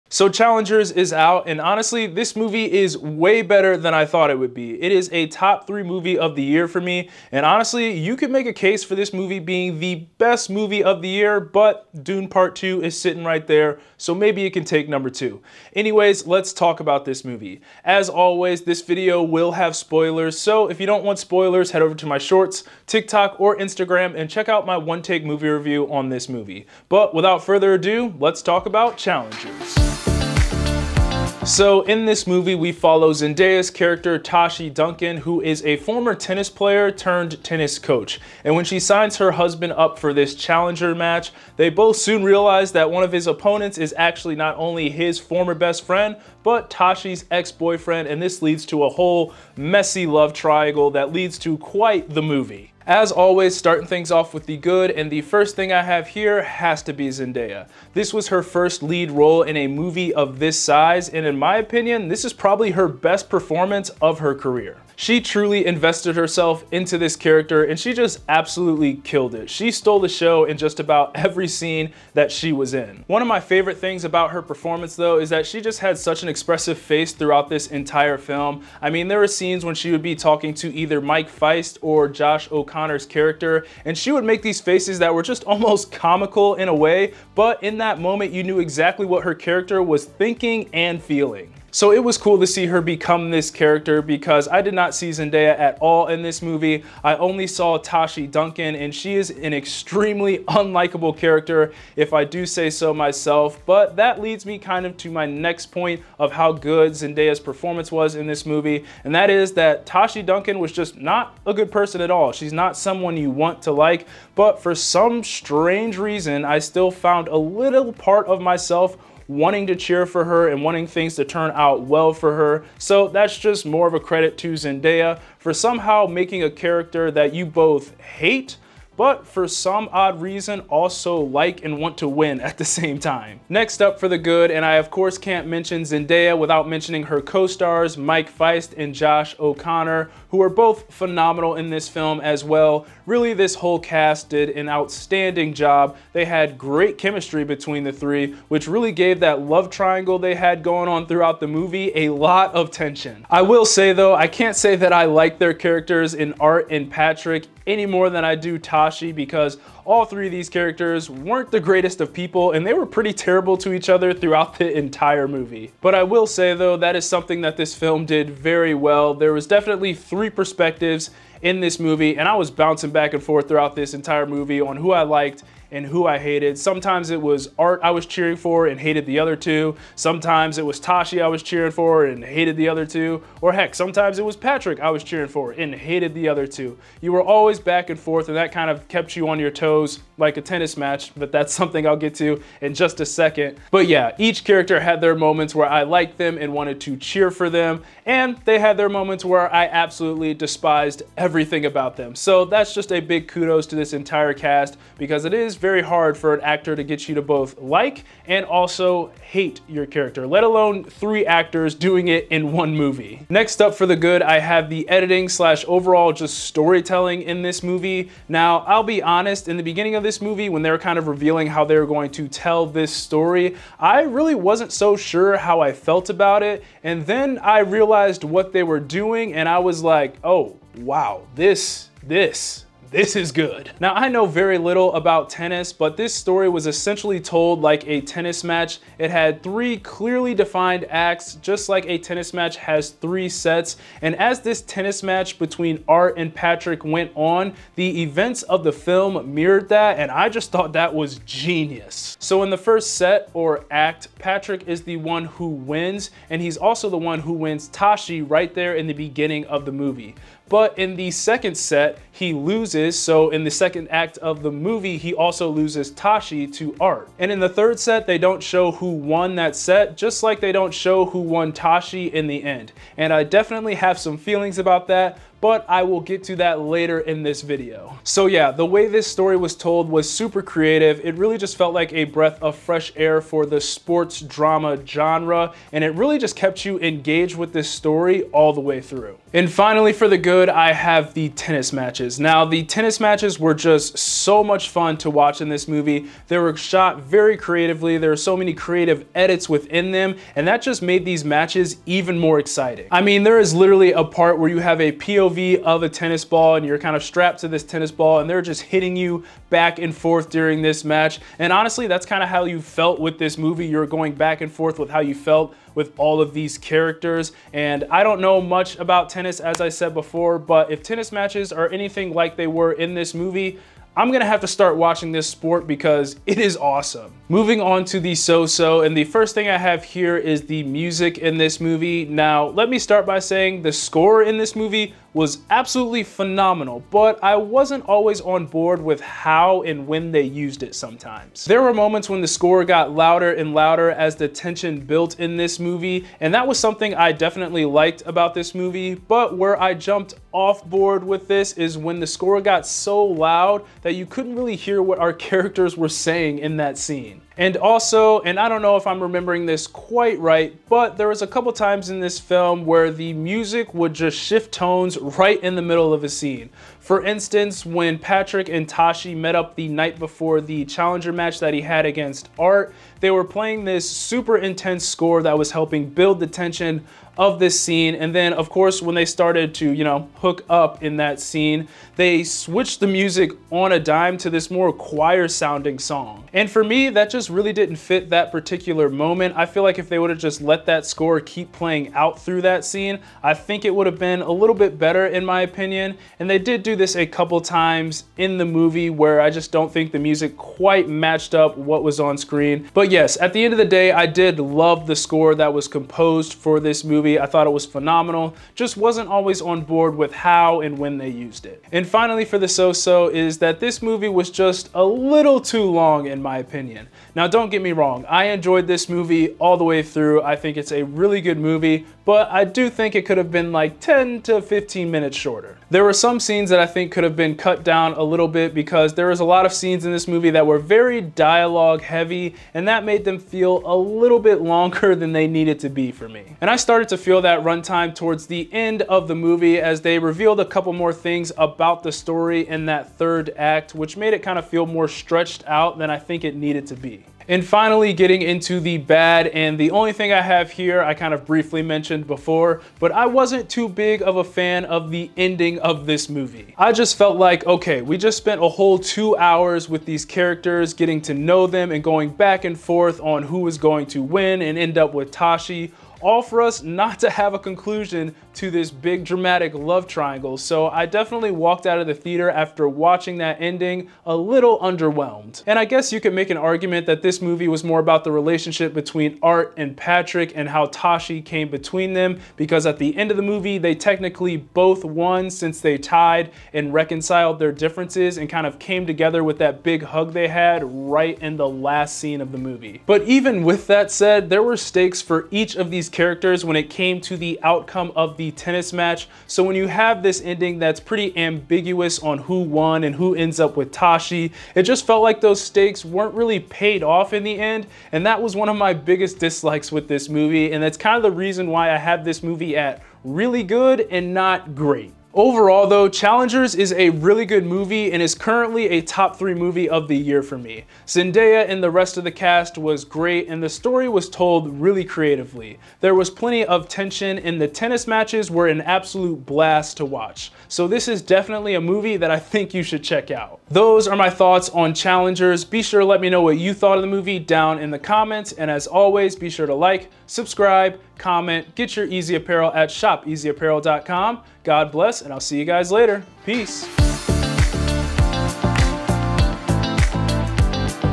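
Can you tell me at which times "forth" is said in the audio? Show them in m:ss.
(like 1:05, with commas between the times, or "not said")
2:53, 3:07, 5:09, 5:14, 7:42.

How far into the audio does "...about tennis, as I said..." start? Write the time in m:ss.
5:18.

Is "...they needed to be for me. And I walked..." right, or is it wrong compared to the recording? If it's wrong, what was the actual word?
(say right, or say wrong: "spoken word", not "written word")
wrong: "started", not "walked".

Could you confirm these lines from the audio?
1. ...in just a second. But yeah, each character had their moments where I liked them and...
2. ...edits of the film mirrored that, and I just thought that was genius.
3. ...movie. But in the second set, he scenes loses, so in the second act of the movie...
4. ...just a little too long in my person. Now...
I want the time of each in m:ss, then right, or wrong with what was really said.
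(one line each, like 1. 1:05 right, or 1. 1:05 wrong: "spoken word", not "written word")
1. 3:12 right
2. 4:08 wrong: "events", not "edits"
3. 4:19 wrong: "loses", not "scenes"
4. 6:54 wrong: "opinion", not "person".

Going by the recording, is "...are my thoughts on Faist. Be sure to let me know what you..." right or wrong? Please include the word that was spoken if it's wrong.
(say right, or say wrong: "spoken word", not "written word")
wrong: "Challengers", not "Faist".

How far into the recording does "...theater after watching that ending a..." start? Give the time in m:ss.
7:51.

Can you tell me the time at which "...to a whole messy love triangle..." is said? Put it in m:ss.
0:48.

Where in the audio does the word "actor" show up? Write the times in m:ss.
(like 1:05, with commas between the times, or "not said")
3:26, 3:31.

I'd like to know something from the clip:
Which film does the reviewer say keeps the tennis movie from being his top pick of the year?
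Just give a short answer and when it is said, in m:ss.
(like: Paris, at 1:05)
Dune Part 2, at 0:12.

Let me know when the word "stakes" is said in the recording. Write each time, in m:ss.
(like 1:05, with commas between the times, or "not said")
8:14, 8:25.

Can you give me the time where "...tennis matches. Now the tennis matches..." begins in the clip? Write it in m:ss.
4:51.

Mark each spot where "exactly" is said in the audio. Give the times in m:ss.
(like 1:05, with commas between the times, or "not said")
1:28.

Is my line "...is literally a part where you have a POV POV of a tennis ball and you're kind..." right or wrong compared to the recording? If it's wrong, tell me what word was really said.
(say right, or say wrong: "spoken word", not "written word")
right.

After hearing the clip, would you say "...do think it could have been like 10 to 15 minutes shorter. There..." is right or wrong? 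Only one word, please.
right.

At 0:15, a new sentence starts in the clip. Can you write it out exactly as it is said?
Anyways, let's talk about this movie.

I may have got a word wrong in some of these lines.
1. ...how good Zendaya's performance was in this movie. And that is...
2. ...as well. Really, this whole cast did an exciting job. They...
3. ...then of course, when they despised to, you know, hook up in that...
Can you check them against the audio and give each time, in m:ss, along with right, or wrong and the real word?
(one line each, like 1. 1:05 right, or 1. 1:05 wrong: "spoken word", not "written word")
1. 1:46 right
2. 2:22 wrong: "outstanding", not "exciting"
3. 6:18 wrong: "started", not "despised".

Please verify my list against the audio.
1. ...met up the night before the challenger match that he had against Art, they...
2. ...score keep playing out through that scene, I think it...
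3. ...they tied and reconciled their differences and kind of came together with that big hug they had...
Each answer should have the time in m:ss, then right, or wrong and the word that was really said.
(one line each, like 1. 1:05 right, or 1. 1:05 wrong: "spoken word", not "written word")
1. 6:09 right
2. 6:30 right
3. 8:05 right.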